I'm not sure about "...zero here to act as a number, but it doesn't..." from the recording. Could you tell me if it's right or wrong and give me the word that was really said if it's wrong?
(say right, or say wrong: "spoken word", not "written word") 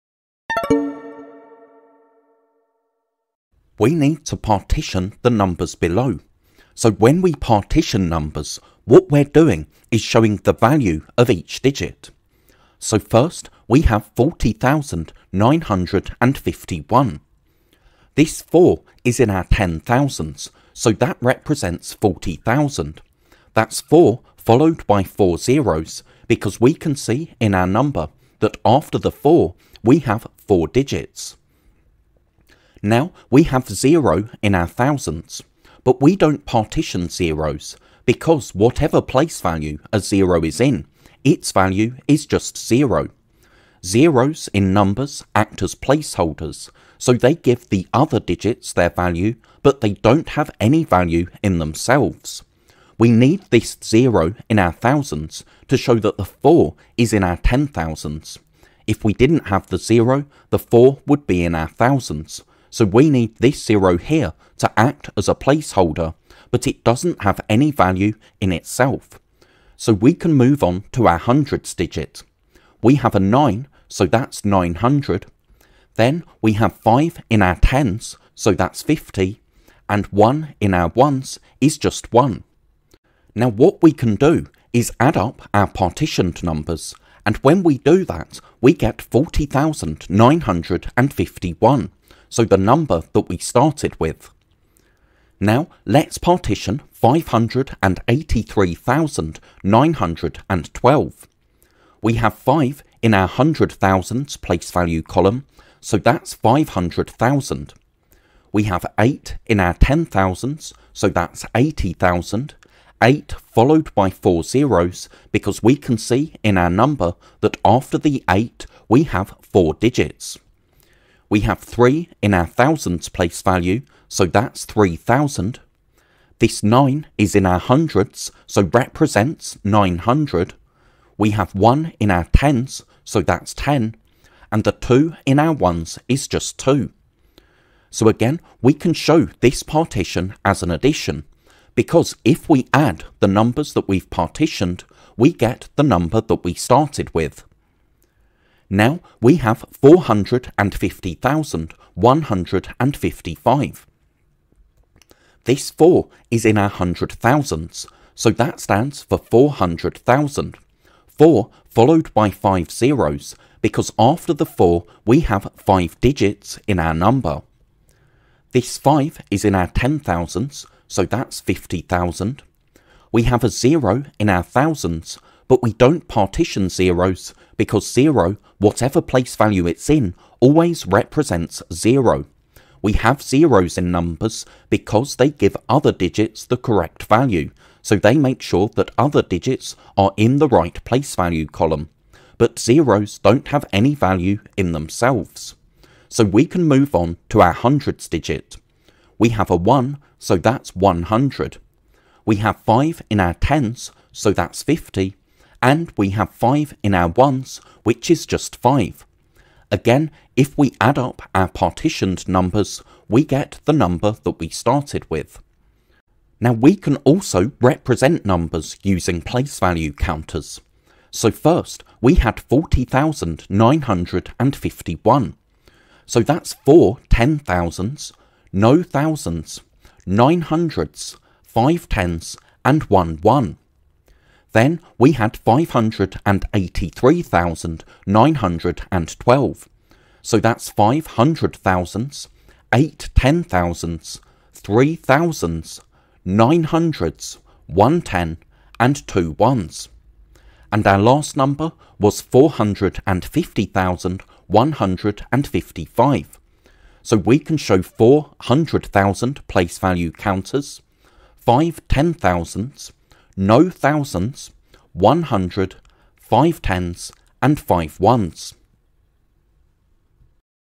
wrong: "placeholder", not "number".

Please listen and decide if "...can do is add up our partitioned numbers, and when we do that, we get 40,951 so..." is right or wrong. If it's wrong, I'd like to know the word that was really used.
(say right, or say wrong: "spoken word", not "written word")
right.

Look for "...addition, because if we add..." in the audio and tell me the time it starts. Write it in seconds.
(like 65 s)
140 s.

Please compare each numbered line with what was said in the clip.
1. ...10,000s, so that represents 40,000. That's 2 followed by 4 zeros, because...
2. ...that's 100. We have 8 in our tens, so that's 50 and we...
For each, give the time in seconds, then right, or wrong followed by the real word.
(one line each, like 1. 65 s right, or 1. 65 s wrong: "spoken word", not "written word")
1. 19 s wrong: "4", not "2"
2. 200 s wrong: "5", not "8".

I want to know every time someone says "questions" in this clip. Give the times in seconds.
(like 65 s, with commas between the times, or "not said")
not said.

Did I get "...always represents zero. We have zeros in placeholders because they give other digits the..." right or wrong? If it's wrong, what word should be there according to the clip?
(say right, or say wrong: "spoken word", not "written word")
wrong: "numbers", not "placeholders".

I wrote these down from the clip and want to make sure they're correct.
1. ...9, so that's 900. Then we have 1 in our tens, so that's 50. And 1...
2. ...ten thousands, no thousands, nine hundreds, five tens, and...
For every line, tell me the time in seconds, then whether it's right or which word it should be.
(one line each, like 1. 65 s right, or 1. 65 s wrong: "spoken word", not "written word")
1. 73 s wrong: "5", not "1"
2. 227 s right.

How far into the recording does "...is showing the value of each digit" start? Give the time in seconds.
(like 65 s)
9 s.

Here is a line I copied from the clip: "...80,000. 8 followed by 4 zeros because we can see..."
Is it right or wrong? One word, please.
right.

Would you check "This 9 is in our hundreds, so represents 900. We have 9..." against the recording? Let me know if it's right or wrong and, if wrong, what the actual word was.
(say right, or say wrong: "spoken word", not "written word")
wrong: "1", not "9".